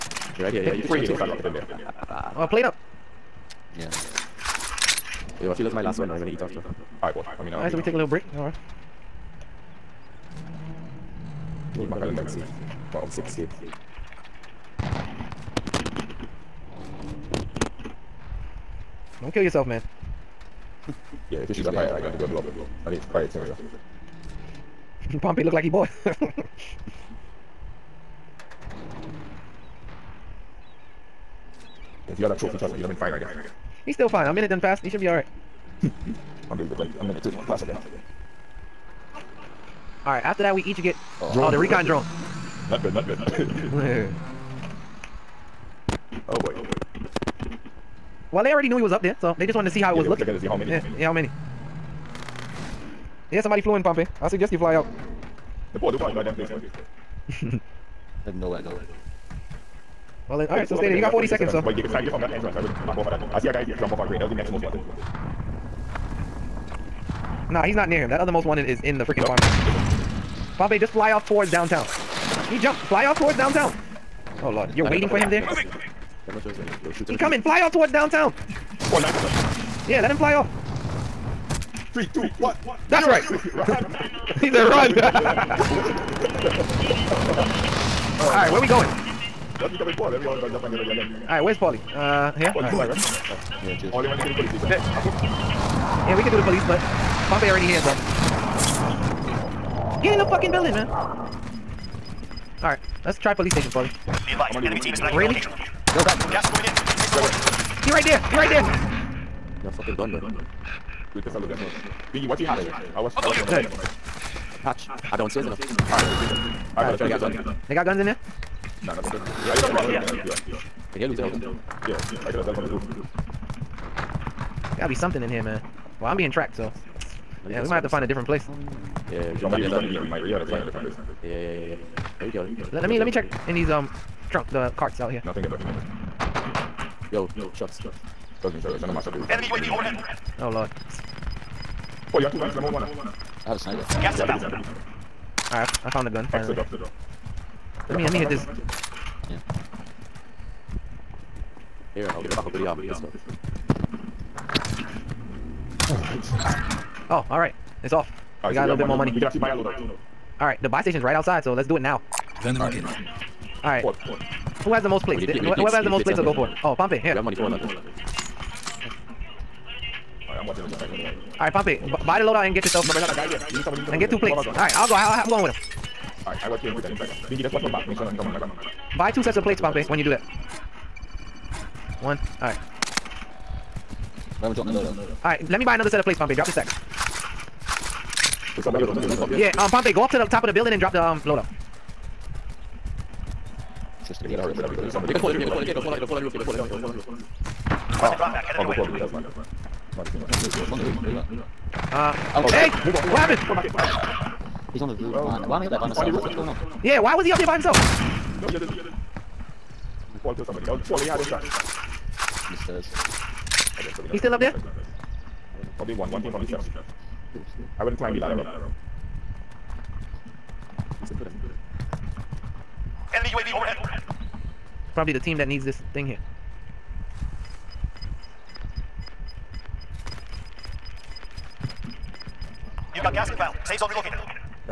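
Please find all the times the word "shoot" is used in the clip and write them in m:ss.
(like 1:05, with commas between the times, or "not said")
0:21, 1:16.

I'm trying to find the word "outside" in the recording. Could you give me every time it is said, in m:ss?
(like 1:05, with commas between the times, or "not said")
2:41.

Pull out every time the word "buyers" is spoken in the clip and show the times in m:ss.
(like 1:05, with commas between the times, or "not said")
not said.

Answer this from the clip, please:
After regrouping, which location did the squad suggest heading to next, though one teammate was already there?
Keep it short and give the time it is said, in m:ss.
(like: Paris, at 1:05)
police station, at 1:43.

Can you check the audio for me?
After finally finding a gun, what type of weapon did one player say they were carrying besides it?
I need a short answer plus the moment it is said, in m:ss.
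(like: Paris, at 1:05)
sniper, at 2:23.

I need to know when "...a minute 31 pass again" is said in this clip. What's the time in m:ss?
0:36.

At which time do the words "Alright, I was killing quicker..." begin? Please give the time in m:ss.
2:56.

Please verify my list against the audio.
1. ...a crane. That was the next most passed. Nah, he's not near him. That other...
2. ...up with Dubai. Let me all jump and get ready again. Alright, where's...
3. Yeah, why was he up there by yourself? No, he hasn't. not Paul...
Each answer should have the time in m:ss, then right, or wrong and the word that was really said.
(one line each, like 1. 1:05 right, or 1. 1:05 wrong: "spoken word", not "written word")
1. 1:03 wrong: "wanted", not "passed"
2. 1:29 wrong: "Paul", not "Dubai"
3. 3:26 wrong: "himself", not "yourself".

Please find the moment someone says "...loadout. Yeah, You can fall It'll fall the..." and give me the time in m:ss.
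3:11.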